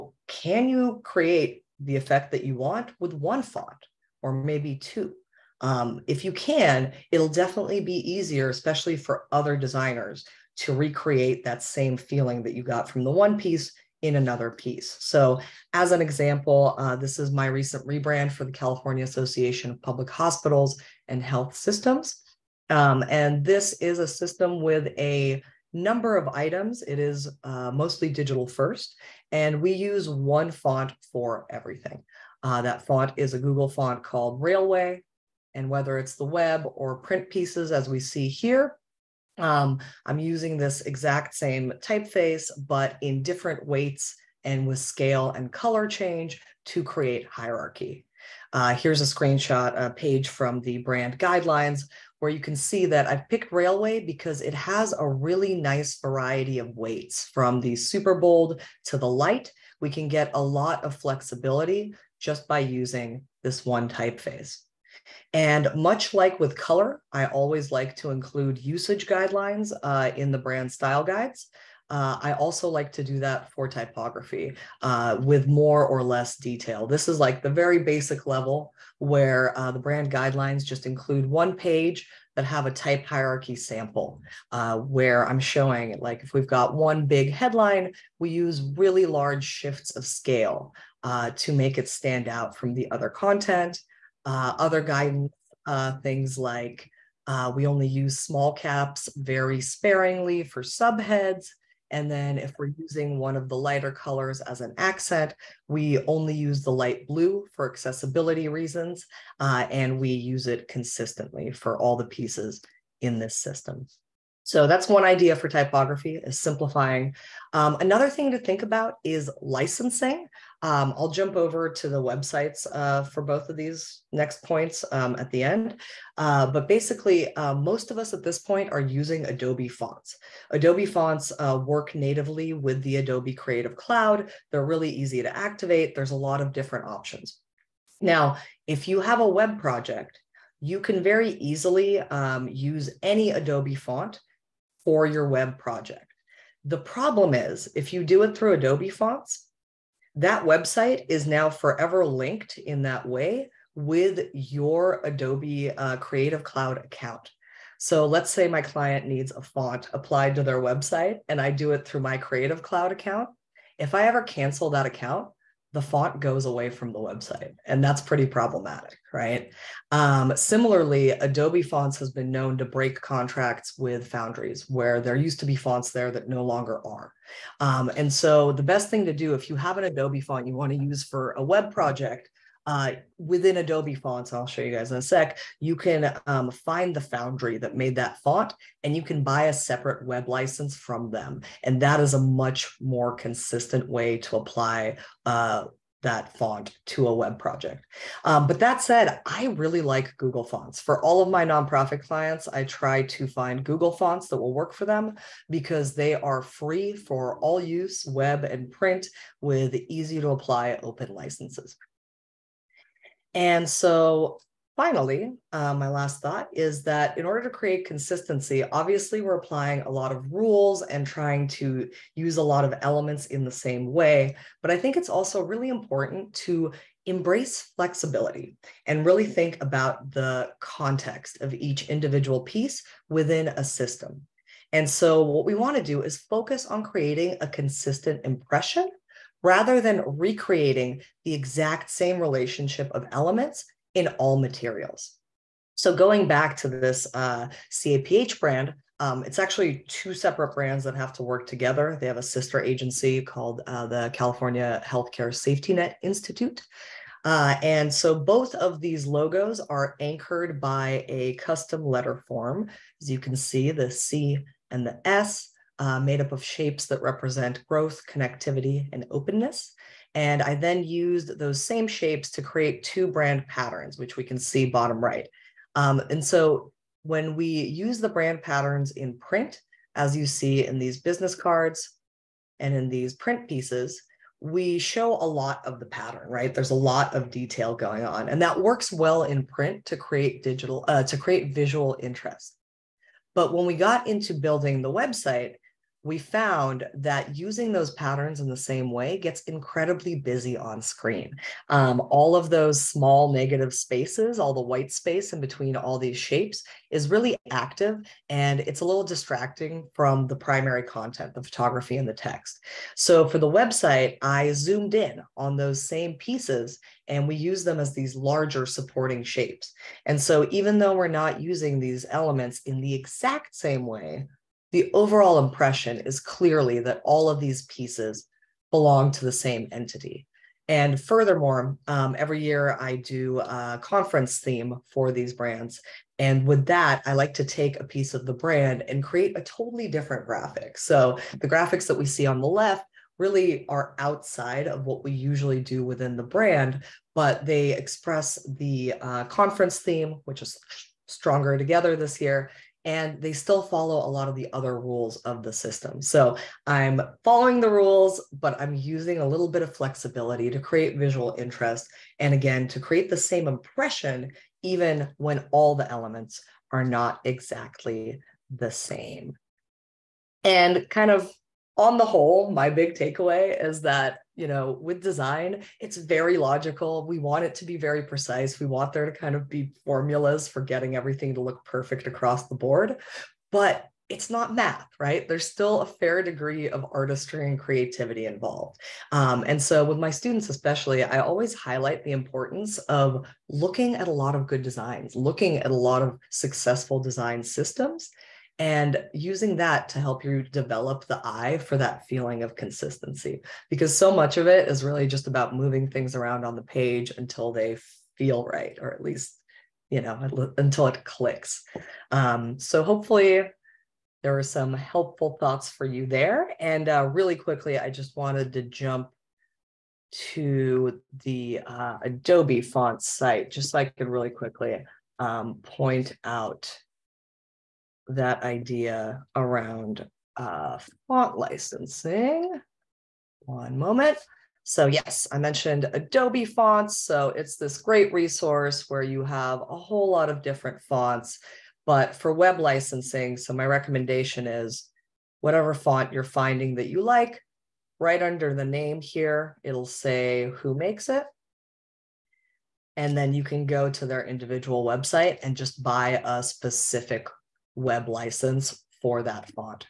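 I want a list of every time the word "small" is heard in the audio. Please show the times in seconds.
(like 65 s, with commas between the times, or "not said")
98 s, 302 s.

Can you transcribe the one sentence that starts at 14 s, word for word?
So, as an example, uh, this is my recent rebrand for the California Association of Public Hospitals and Health Systems.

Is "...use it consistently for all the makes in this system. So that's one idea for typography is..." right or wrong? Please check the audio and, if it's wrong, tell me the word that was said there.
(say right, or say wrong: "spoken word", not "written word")
wrong: "pieces", not "makes".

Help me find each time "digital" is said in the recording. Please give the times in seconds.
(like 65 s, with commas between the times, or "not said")
28 s, 290 s.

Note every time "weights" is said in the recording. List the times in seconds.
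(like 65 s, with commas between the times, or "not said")
43 s, 56 s.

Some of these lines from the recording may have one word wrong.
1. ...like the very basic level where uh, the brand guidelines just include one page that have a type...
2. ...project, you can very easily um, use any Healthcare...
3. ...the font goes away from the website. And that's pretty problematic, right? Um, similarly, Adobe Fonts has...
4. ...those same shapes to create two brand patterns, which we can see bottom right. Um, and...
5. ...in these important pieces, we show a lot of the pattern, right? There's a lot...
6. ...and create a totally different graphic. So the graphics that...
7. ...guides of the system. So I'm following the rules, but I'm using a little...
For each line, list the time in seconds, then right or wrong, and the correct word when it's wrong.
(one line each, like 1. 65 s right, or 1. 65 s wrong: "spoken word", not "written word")
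1. 77 s right
2. 139 s wrong: "Adobe", not "Healthcare"
3. 165 s right
4. 271 s right
5. 282 s wrong: "print", not "important"
6. 338 s right
7. 354 s wrong: "rules", not "guides".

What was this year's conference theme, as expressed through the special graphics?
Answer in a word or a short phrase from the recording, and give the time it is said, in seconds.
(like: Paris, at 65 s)
stronger together, at 351 s.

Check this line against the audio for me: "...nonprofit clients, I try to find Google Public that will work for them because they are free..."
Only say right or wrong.
wrong.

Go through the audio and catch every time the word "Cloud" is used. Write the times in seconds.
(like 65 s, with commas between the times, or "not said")
133 s, 156 s, 162 s.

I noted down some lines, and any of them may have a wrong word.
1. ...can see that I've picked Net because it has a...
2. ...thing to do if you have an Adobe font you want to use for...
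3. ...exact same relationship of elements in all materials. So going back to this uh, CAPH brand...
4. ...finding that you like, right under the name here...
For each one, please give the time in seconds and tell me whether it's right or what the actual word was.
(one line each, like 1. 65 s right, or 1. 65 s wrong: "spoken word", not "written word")
1. 52 s wrong: "Raleway", not "Net"
2. 178 s right
3. 241 s right
4. 446 s right.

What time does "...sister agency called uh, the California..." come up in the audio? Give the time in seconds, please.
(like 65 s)
252 s.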